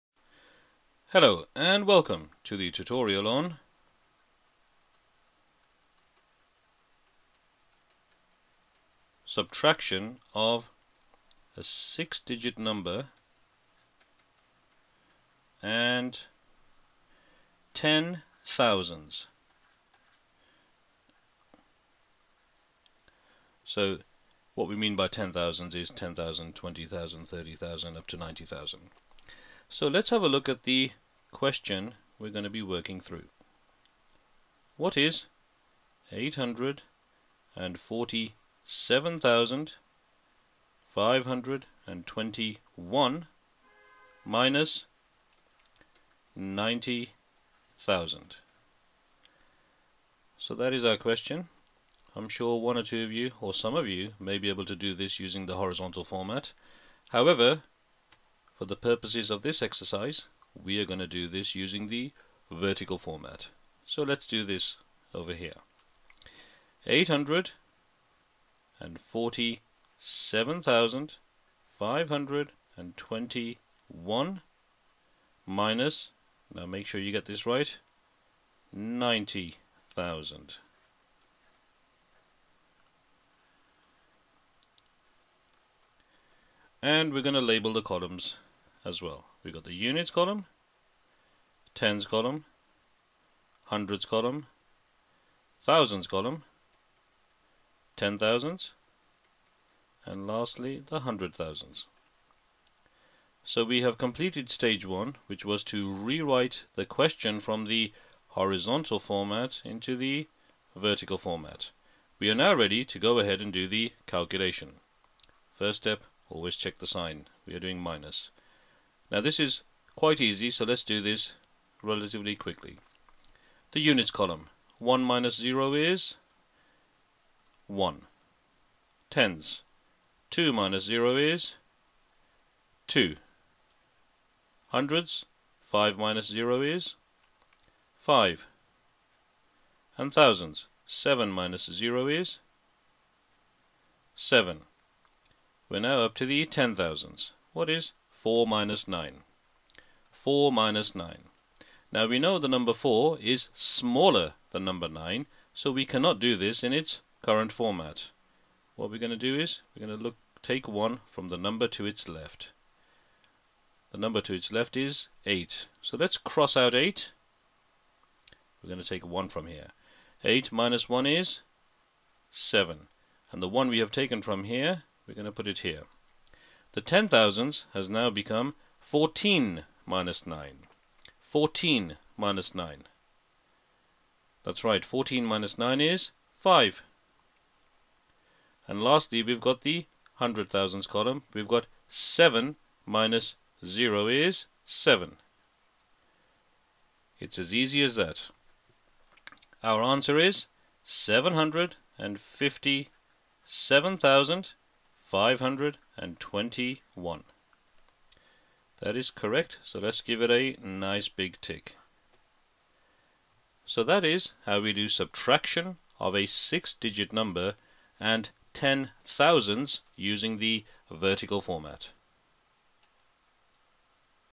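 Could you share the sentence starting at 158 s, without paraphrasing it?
What we're going to do is, we're going to look take 1 from the number to its left.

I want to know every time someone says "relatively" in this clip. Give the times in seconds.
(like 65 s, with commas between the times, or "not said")
121 s.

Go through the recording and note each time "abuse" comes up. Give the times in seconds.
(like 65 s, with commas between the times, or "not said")
not said.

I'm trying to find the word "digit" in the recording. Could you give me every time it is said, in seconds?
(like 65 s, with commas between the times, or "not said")
12 s, 216 s.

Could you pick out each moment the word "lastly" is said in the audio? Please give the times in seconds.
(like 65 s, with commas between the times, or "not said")
100 s, 188 s.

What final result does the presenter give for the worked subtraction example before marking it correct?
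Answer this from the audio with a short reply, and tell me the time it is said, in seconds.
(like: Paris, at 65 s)
757,521, at 200 s.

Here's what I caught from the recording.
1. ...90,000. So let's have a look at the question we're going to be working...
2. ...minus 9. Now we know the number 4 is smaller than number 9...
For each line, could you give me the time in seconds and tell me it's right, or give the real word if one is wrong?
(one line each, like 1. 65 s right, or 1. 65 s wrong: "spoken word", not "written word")
1. 28 s right
2. 150 s right.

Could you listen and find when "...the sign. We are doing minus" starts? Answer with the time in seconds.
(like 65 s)
116 s.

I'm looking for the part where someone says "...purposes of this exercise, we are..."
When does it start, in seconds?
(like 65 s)
58 s.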